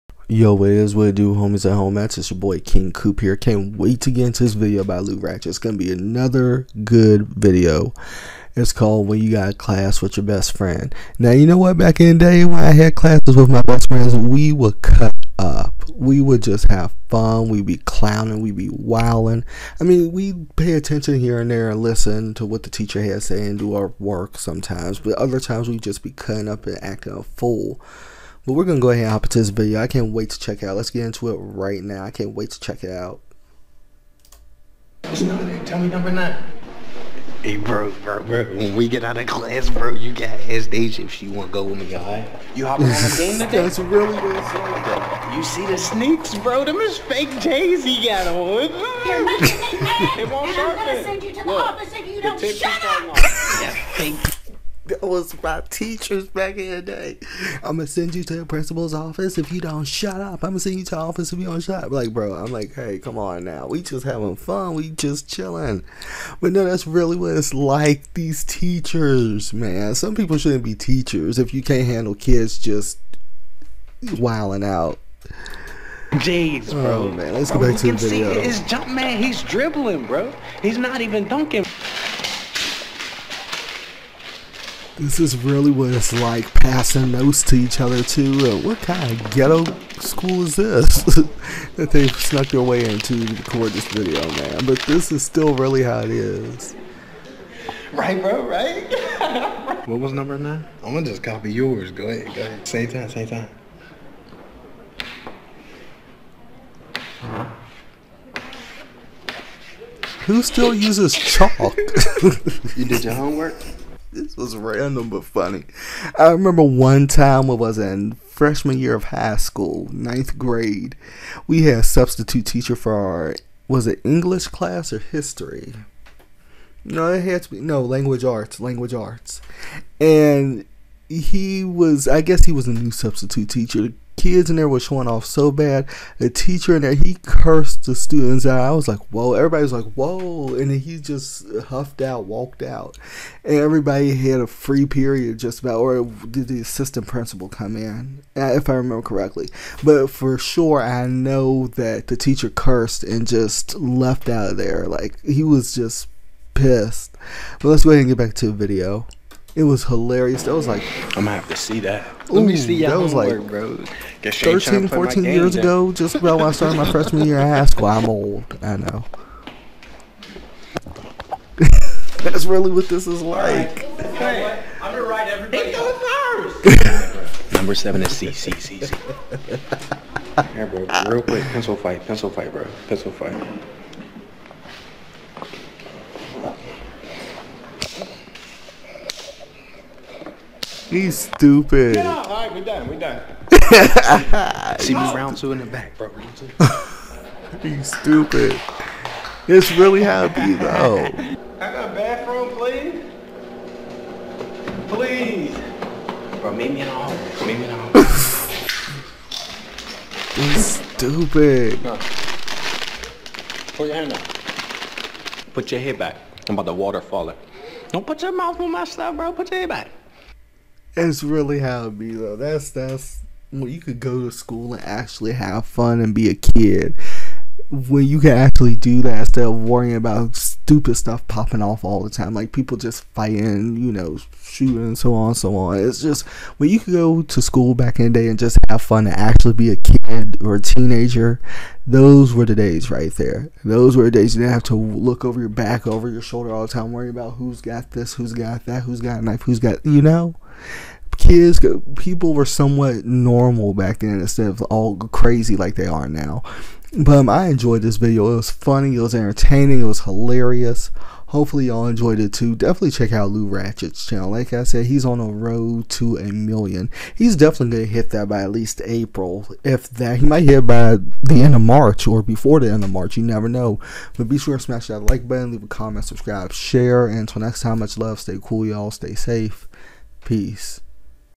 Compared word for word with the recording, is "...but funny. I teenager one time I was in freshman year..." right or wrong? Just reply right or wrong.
wrong.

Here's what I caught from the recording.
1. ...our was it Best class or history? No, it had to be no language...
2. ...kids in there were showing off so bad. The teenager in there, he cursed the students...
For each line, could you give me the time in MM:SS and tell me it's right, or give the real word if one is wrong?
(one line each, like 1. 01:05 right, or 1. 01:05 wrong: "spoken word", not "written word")
1. 02:02 wrong: "English", not "Best"
2. 02:14 wrong: "teacher", not "teenager".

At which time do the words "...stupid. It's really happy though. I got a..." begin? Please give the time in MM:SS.
03:17.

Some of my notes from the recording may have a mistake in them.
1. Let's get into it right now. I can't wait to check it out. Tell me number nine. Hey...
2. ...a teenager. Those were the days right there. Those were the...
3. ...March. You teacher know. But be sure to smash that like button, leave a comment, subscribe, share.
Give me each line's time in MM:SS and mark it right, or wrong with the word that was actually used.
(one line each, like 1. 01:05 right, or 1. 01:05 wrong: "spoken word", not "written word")
1. 00:30 right
2. 04:00 right
3. 04:32 wrong: "never", not "teacher".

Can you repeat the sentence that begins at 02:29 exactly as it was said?
But for sure, I know that the teacher cursed and just left out of there.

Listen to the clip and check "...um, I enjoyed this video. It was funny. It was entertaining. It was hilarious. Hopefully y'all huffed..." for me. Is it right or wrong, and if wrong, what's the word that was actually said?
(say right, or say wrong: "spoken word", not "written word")
wrong: "enjoyed", not "huffed".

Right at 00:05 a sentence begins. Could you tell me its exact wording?
It's gonna be another good video.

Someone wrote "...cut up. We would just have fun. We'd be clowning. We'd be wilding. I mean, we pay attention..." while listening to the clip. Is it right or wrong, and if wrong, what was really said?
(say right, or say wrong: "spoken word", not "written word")
right.